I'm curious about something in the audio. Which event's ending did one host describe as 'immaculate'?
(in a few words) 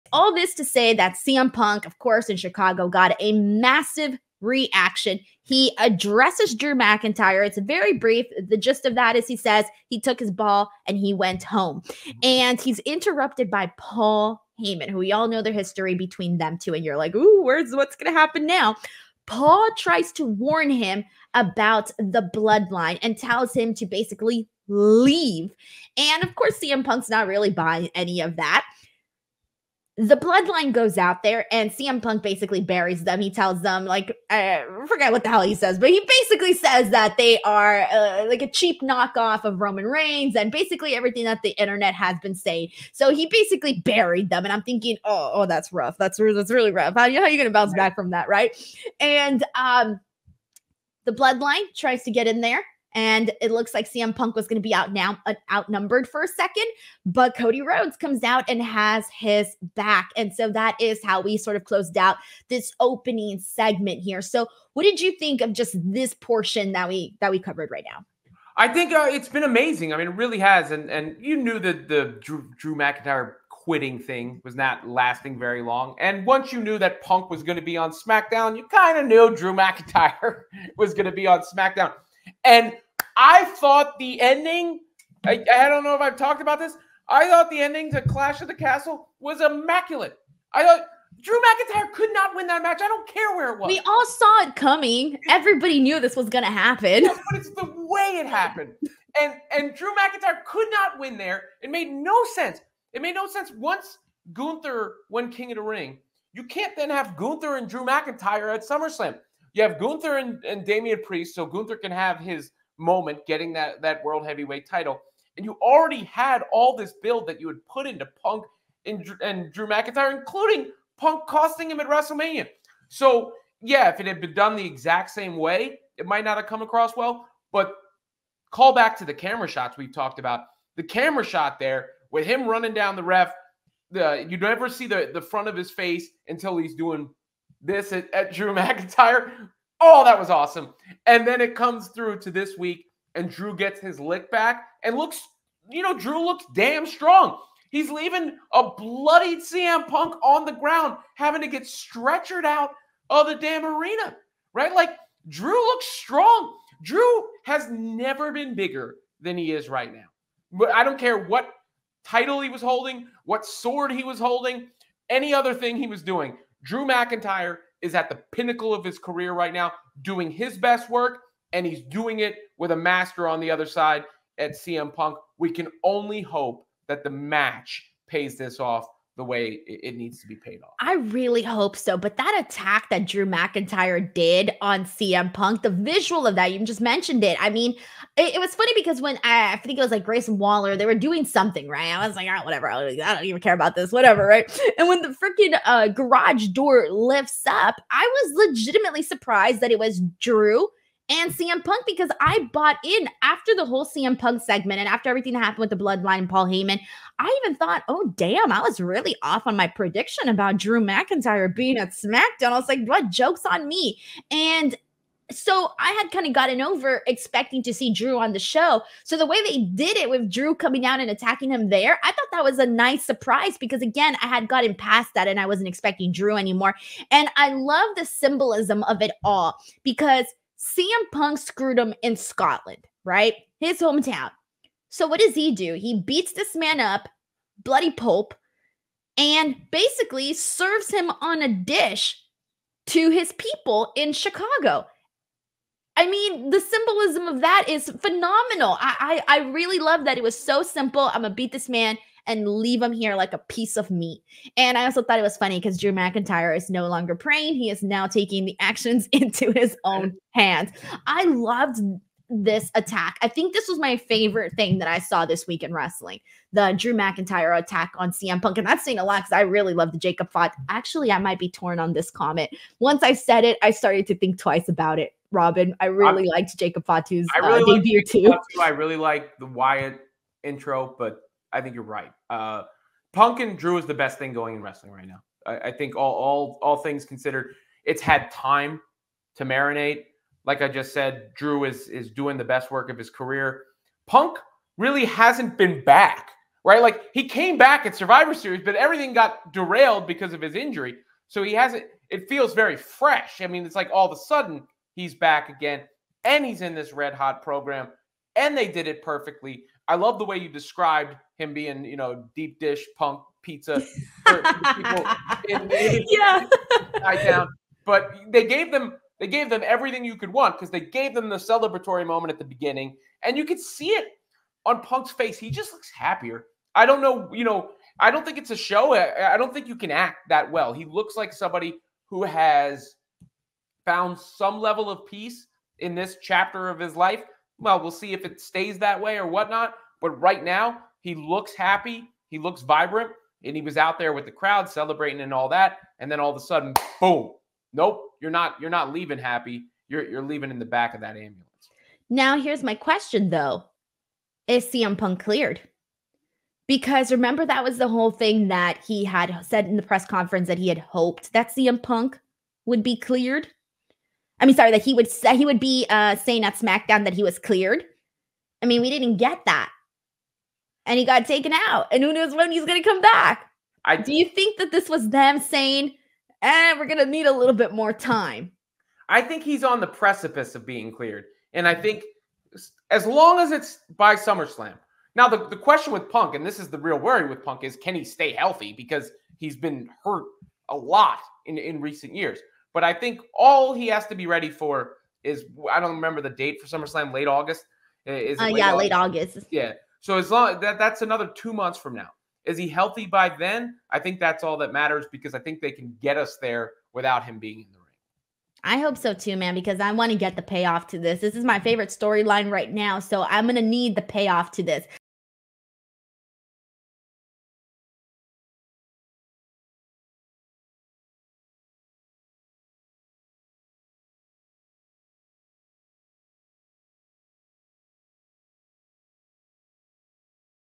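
Clash of the Castle.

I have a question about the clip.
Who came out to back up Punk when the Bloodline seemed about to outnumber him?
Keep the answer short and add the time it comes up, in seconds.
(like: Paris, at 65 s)
Cody Rhodes, at 57 s.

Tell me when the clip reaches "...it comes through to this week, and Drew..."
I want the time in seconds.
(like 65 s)
141 s.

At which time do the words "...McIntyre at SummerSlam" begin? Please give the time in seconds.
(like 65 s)
107 s.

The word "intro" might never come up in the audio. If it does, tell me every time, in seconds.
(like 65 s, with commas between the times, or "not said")
280 s.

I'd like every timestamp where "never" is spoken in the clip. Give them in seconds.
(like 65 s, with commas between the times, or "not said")
134 s, 157 s.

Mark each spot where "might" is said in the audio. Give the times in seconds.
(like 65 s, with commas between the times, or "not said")
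126 s, 271 s.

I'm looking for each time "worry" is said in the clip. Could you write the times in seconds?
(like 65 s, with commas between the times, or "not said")
386 s.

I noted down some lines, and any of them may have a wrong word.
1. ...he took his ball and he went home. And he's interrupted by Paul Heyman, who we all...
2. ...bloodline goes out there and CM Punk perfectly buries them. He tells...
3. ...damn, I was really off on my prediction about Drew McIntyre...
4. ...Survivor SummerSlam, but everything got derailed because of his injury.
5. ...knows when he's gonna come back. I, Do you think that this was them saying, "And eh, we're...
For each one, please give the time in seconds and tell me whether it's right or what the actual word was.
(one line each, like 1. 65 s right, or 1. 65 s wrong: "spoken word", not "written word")
1. 9 s right
2. 30 s wrong: "basically", not "perfectly"
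3. 208 s right
4. 297 s wrong: "Series", not "SummerSlam"
5. 372 s right.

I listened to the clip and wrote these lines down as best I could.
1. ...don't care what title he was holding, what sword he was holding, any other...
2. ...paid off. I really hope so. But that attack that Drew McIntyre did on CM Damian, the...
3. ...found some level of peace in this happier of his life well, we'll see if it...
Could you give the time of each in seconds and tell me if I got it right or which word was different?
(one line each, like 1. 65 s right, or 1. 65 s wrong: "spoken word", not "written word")
1. 160 s right
2. 180 s wrong: "Punk", not "Damian"
3. 333 s wrong: "chapter", not "happier".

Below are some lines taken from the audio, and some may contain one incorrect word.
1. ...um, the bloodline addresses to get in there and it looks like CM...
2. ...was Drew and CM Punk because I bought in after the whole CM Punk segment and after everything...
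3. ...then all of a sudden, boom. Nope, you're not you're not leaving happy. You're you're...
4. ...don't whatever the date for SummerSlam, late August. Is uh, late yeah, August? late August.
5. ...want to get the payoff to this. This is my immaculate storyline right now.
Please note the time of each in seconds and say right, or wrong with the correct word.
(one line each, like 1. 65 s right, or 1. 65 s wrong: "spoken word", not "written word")
1. 49 s wrong: "tries", not "addresses"
2. 199 s right
3. 346 s right
4. 395 s wrong: "remember", not "whatever"
5. 409 s wrong: "favorite", not "immaculate".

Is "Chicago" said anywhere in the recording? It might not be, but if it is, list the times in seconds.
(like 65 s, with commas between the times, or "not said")
2 s, 244 s.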